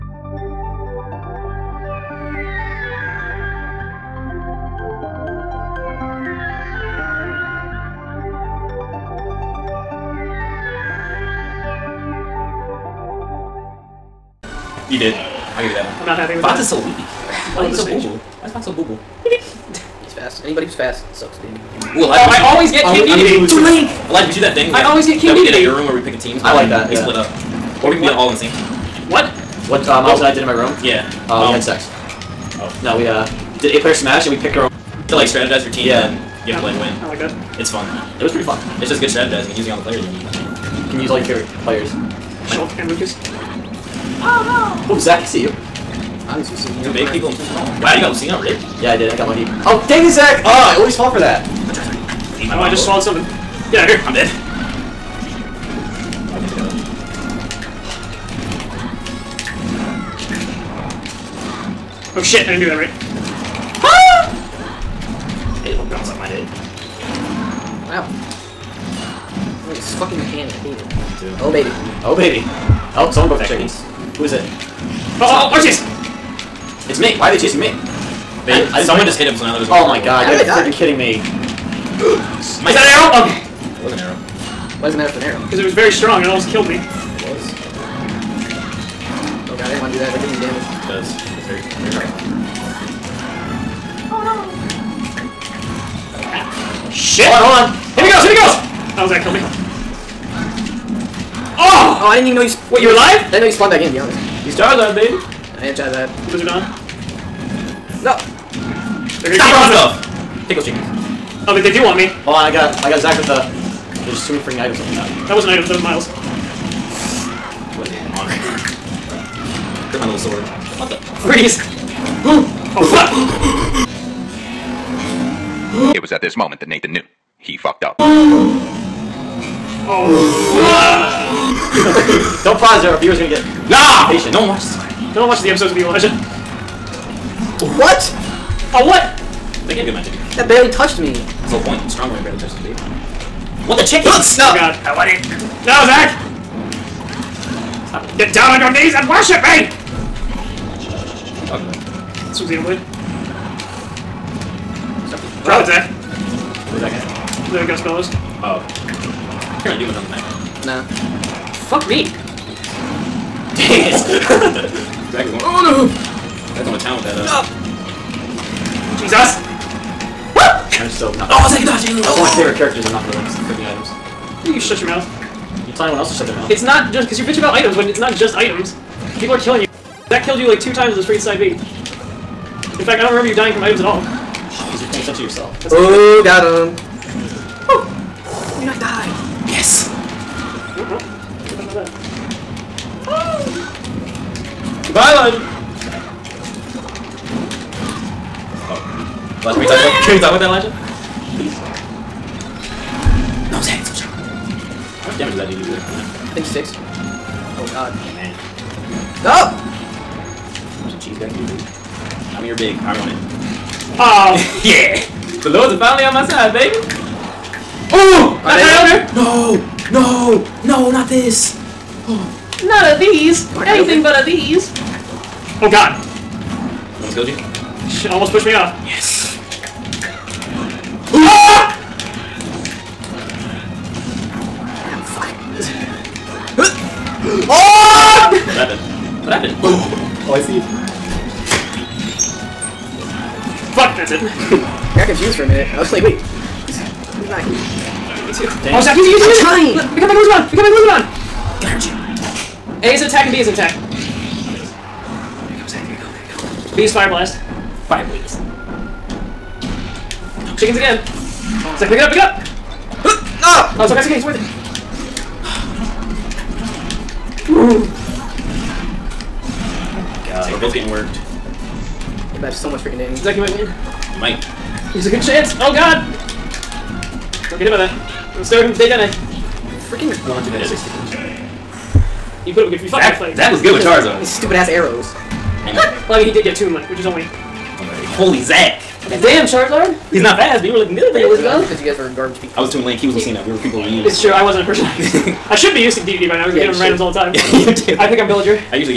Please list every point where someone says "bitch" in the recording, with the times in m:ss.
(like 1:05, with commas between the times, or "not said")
2:57.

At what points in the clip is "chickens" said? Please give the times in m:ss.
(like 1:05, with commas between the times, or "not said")
1:13, 1:50, 2:23, 4:20.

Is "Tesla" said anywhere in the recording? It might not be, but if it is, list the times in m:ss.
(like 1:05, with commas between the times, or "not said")
not said.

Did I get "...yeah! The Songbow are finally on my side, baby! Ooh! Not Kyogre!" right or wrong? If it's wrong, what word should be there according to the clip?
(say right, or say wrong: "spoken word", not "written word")
wrong: "Lords", not "Songbow".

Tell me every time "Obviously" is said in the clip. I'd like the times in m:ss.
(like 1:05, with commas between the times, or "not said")
0:46.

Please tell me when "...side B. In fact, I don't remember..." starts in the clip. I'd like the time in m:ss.
3:01.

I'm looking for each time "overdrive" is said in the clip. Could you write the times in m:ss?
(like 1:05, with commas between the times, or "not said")
not said.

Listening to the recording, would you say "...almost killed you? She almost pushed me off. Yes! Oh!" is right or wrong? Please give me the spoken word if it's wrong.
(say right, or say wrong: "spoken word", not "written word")
right.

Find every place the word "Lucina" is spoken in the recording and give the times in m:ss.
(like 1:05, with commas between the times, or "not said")
0:48, 4:53.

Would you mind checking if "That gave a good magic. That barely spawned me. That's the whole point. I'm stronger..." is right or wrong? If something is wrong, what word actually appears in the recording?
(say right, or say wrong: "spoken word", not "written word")
wrong: "touched", not "spawned".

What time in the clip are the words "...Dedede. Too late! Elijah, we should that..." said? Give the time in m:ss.
0:23.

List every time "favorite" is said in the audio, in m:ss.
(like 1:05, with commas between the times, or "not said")
0:41, 2:52.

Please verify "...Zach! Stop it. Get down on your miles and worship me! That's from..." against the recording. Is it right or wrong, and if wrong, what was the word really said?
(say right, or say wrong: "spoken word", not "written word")
wrong: "knees", not "miles".